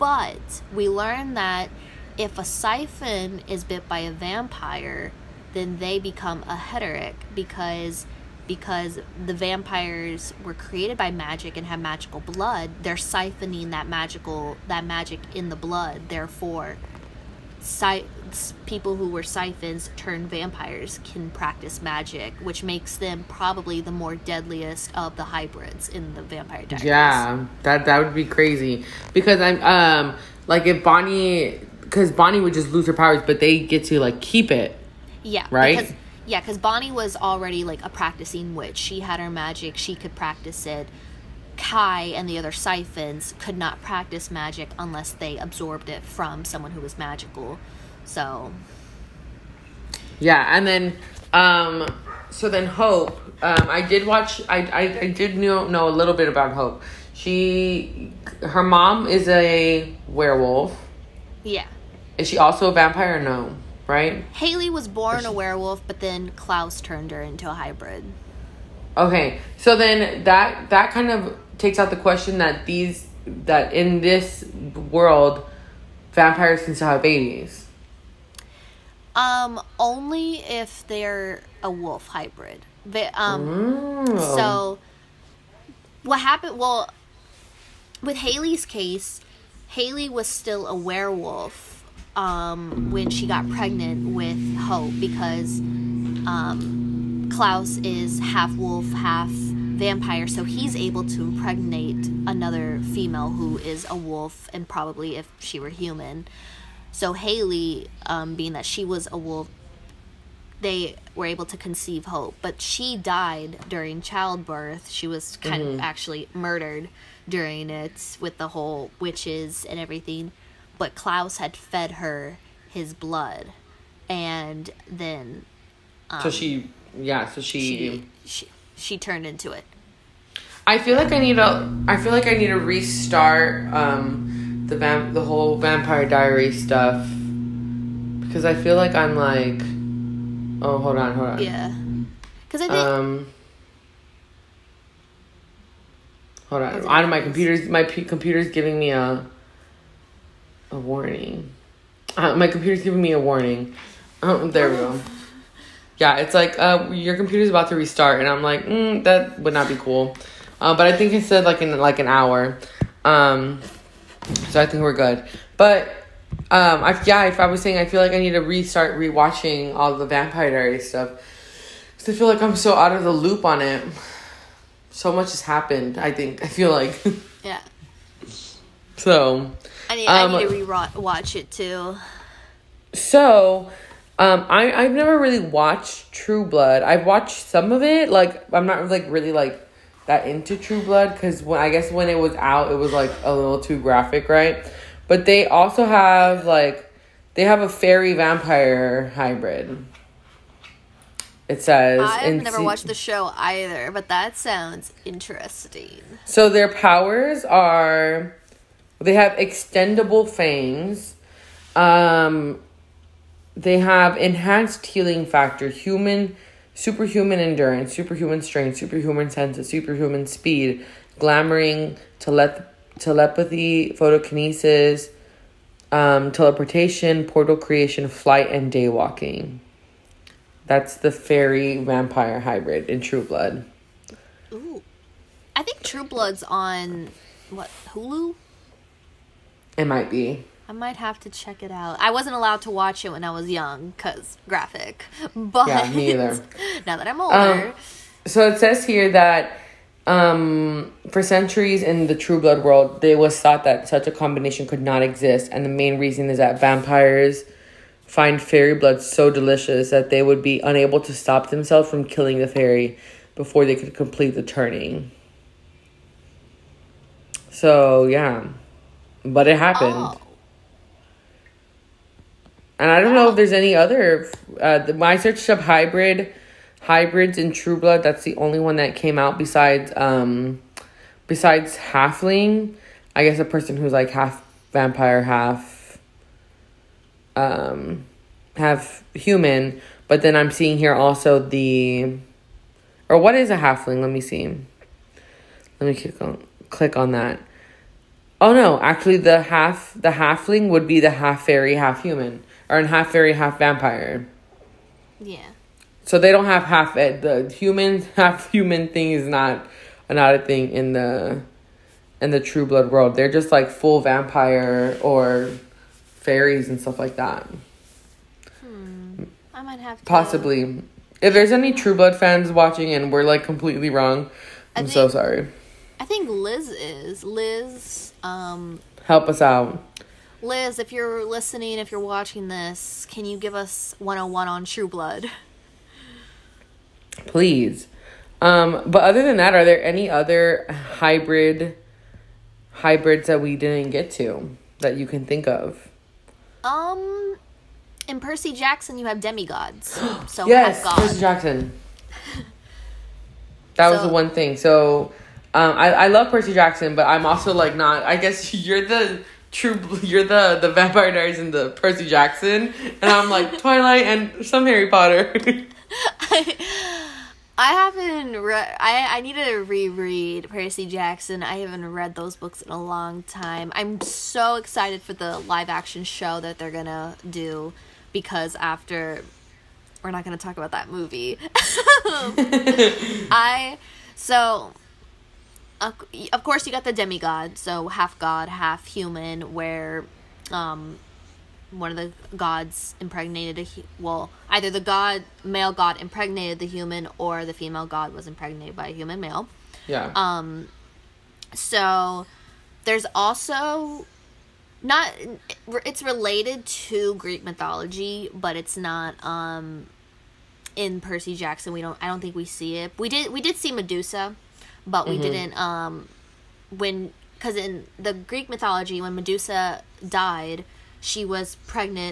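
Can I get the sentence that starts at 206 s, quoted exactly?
So their powers are they have extendable fangs.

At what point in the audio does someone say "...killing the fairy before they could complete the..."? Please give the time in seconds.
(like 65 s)
262 s.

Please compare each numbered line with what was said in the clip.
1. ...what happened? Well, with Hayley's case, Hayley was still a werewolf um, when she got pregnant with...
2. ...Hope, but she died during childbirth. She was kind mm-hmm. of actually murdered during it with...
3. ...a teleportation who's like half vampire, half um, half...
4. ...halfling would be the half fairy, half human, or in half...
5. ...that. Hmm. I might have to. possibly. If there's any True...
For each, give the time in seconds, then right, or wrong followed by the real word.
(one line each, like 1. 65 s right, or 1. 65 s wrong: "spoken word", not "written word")
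1. 86 s right
2. 112 s right
3. 283 s wrong: "person", not "teleportation"
4. 300 s right
5. 317 s right.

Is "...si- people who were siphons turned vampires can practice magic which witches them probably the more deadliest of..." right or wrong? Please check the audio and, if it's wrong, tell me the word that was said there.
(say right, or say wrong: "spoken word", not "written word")
wrong: "makes", not "witches".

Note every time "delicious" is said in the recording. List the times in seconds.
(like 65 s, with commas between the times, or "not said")
259 s.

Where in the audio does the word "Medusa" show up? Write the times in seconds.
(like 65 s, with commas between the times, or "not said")
413 s, 419 s.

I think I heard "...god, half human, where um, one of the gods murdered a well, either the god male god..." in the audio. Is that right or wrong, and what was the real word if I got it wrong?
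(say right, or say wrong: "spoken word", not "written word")
wrong: "impregnated", not "murdered".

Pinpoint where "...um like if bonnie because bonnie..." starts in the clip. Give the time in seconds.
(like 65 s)
29 s.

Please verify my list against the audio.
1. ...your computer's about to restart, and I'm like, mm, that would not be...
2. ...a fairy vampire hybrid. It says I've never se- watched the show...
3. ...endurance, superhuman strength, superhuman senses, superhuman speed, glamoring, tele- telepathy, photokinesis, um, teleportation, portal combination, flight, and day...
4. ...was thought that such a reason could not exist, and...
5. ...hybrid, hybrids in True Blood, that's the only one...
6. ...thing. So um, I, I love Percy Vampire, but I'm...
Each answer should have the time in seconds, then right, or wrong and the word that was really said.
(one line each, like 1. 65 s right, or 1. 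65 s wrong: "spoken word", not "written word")
1. 156 s right
2. 197 s right
3. 217 s wrong: "creation", not "combination"
4. 253 s wrong: "combination", not "reason"
5. 275 s right
6. 354 s wrong: "Jackson", not "Vampire".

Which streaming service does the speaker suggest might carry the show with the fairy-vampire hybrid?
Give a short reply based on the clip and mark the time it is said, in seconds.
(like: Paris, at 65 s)
Hulu, at 237 s.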